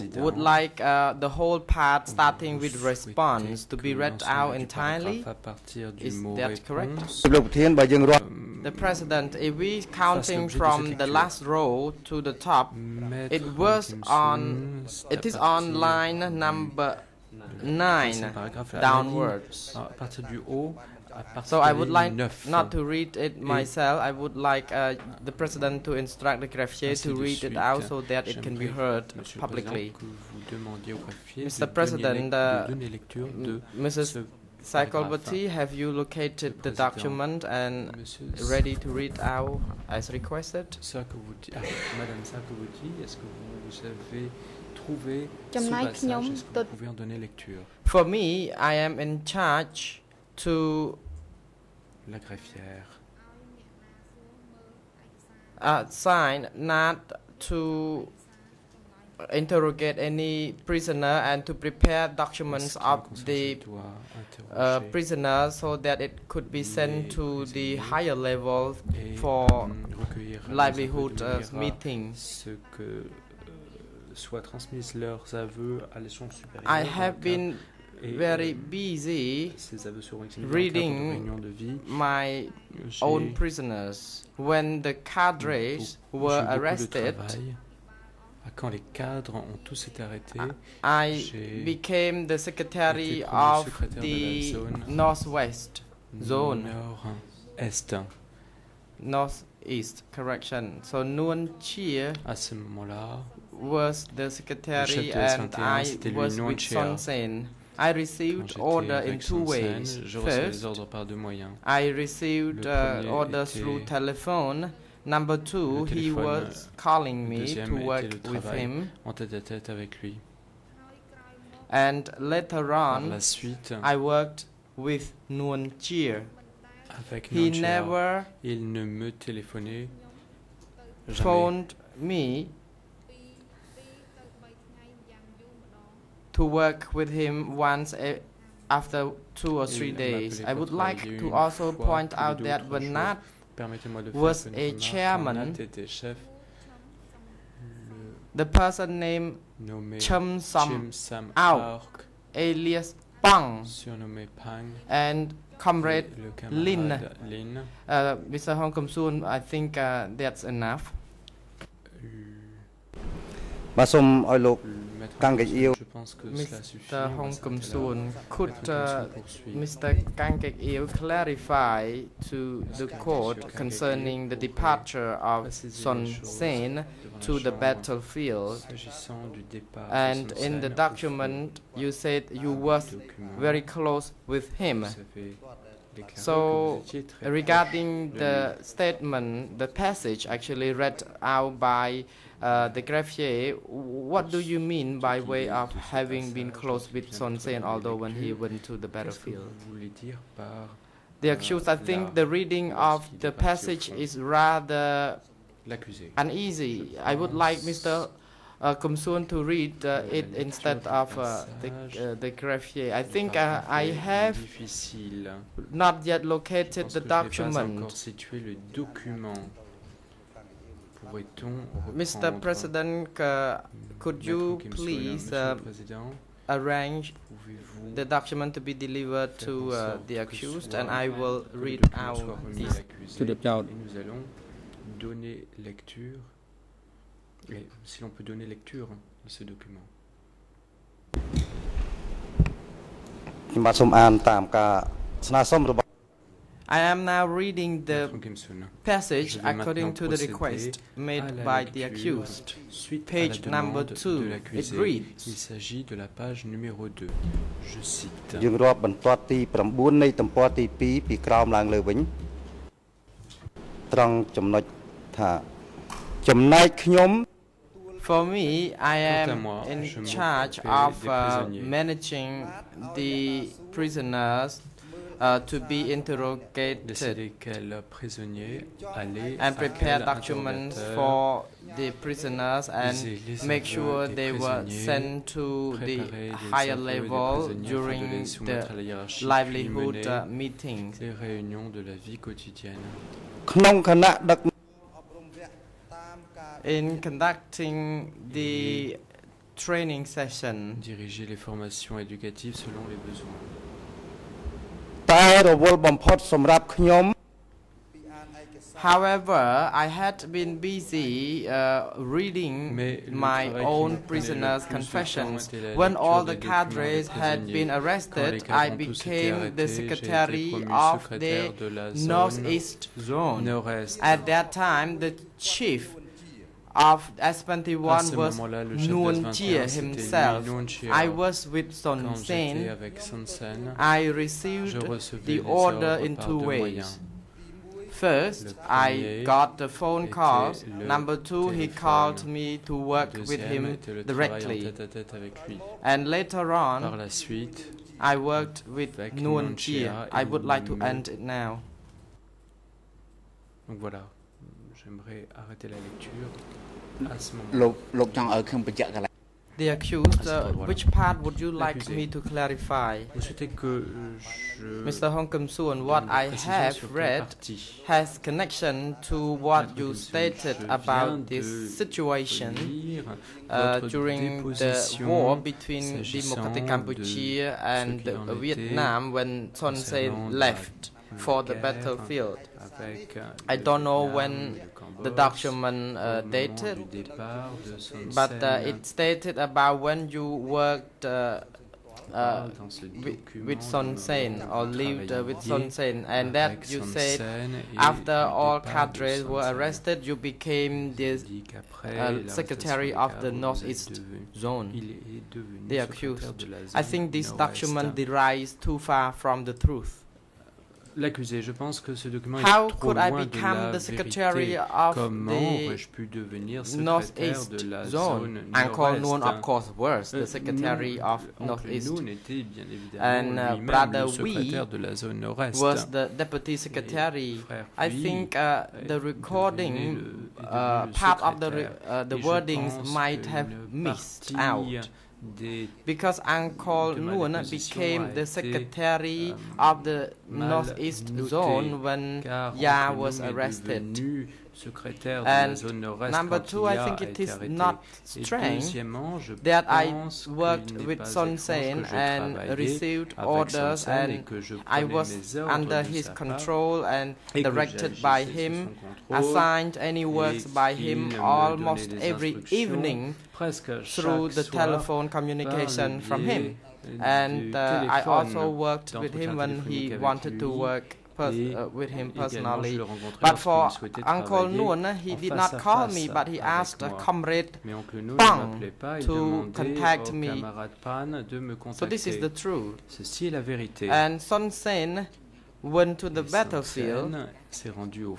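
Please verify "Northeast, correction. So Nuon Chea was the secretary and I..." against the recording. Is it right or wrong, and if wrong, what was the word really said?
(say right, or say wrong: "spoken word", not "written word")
right.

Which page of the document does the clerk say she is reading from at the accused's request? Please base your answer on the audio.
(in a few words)
2.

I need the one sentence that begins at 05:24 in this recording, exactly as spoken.
At that time, the chief of S21 was Nuon Chea himself.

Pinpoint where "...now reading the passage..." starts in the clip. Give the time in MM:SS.
04:07.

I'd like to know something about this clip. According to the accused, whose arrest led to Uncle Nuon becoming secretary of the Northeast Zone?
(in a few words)
Ya.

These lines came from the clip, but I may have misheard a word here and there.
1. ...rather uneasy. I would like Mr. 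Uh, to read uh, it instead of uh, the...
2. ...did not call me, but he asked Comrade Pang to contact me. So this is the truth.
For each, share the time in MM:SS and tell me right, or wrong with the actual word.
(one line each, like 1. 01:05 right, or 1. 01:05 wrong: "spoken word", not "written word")
1. 03:24 right
2. 07:55 right.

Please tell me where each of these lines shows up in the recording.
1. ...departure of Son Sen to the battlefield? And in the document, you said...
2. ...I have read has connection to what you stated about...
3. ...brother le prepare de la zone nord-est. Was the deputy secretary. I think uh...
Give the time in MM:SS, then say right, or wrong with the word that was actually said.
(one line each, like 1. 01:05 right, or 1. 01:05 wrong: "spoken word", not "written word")
1. 02:54 right
2. 06:06 right
3. 07:03 wrong: "secrétaire", not "prepare".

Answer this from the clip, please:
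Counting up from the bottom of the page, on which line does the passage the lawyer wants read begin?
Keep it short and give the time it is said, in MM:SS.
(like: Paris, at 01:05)
9, at 00:15.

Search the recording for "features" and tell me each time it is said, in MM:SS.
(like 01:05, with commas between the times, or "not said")
not said.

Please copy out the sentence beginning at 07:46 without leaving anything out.
And uh, I also worked with him when he wanted to work uh, with him personally.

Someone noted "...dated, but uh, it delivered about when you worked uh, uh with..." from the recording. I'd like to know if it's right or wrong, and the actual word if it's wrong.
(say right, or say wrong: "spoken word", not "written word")
wrong: "stated", not "delivered".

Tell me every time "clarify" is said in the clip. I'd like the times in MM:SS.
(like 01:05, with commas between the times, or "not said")
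02:50, 06:02.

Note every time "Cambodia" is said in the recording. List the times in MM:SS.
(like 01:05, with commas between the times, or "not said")
06:16.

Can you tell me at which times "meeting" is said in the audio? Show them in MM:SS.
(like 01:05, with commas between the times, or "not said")
01:11, 04:50.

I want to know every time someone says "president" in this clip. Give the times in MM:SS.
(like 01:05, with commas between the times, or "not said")
00:08, 00:25, 00:31, 03:42.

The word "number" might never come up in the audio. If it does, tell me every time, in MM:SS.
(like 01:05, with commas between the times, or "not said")
00:16, 01:55, 04:13, 05:40, 07:26.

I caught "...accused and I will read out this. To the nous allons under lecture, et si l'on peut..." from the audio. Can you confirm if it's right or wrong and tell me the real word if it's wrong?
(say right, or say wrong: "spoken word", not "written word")
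wrong: "donner", not "under".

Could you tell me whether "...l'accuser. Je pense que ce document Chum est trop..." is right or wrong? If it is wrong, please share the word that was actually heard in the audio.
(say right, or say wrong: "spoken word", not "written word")
wrong: "How", not "Chum".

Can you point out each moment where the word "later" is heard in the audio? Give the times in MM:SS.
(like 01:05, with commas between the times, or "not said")
02:02, 05:46.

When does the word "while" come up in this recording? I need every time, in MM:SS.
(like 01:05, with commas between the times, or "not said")
not said.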